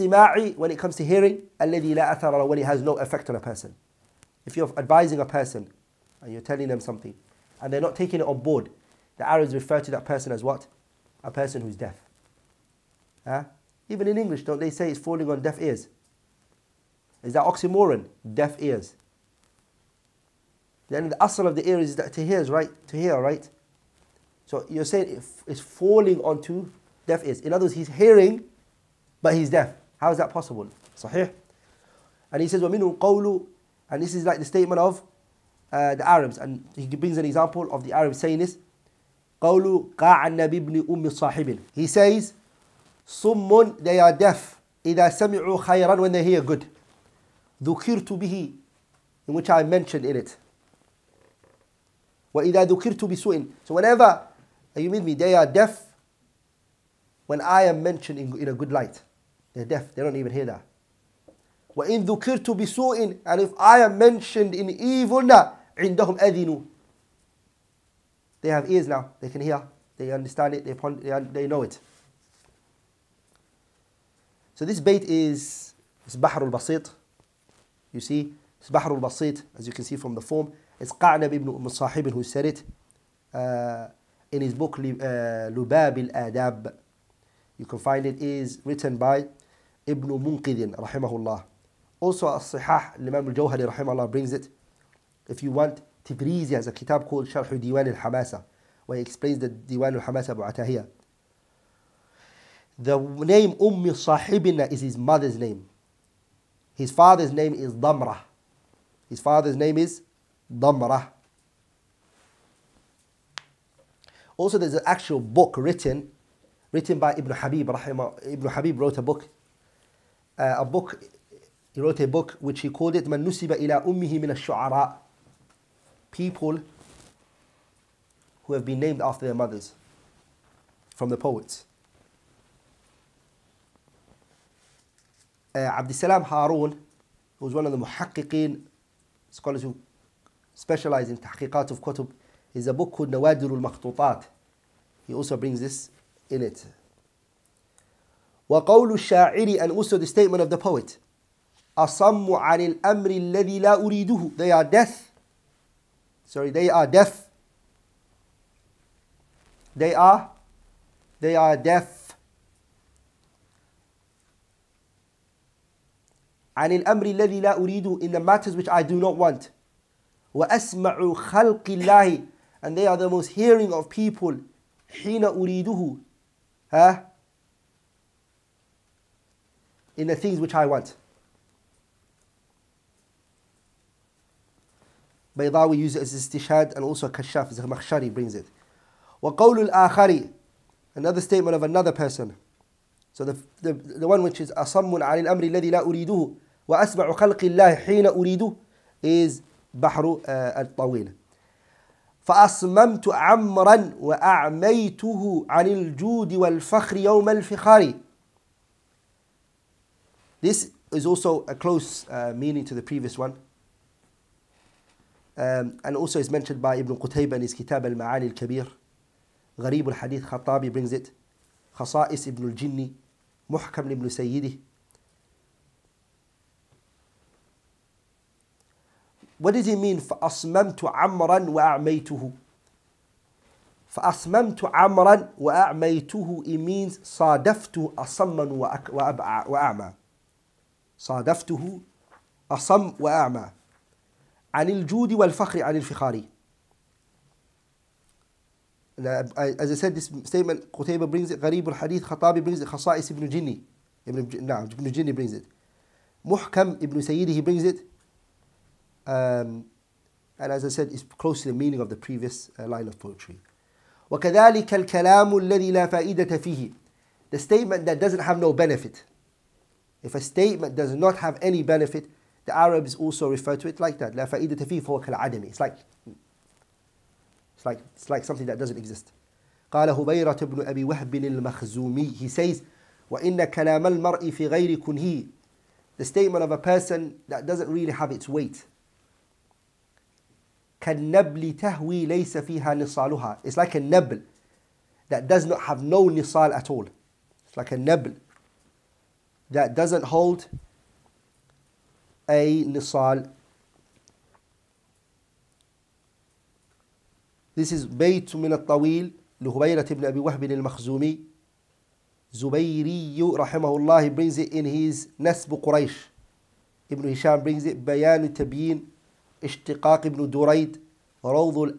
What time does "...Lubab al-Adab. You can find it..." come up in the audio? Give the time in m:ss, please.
1:24.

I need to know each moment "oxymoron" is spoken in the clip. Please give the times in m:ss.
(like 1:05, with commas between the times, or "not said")
0:17.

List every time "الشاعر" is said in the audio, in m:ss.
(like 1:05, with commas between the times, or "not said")
2:28.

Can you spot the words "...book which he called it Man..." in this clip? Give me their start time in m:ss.
2:02.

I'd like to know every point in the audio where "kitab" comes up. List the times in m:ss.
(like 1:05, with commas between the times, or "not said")
1:36, 3:37.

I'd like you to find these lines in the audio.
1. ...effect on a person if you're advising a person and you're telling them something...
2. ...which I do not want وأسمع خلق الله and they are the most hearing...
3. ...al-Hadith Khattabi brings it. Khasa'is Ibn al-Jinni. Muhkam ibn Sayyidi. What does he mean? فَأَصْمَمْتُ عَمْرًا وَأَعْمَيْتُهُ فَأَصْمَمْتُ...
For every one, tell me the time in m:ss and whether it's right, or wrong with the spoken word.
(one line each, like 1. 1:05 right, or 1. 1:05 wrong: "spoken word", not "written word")
1. 0:02 right
2. 2:48 right
3. 3:39 right.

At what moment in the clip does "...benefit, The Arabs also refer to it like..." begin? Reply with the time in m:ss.
4:31.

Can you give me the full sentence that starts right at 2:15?
Uh, salam Harun, who was one of the muhakkiqeen, scholars who specialize in tahqiqat of kutub, is a book called Nawadir al-Makhtutat.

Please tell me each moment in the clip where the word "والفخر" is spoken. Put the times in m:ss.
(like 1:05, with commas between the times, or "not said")
3:26, 4:05.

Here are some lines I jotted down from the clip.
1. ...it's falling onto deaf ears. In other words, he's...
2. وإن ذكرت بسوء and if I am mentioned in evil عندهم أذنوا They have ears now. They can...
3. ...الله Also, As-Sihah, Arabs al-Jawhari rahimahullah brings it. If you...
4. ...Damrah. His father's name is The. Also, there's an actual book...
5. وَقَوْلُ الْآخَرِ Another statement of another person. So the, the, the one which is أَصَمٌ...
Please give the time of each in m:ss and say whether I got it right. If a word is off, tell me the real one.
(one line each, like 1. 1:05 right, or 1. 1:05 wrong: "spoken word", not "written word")
1. 0:25 right
2. 1:01 right
3. 1:31 wrong: "Imam", not "Arabs"
4. 1:47 wrong: "Damrah", not "The"
5. 3:09 right.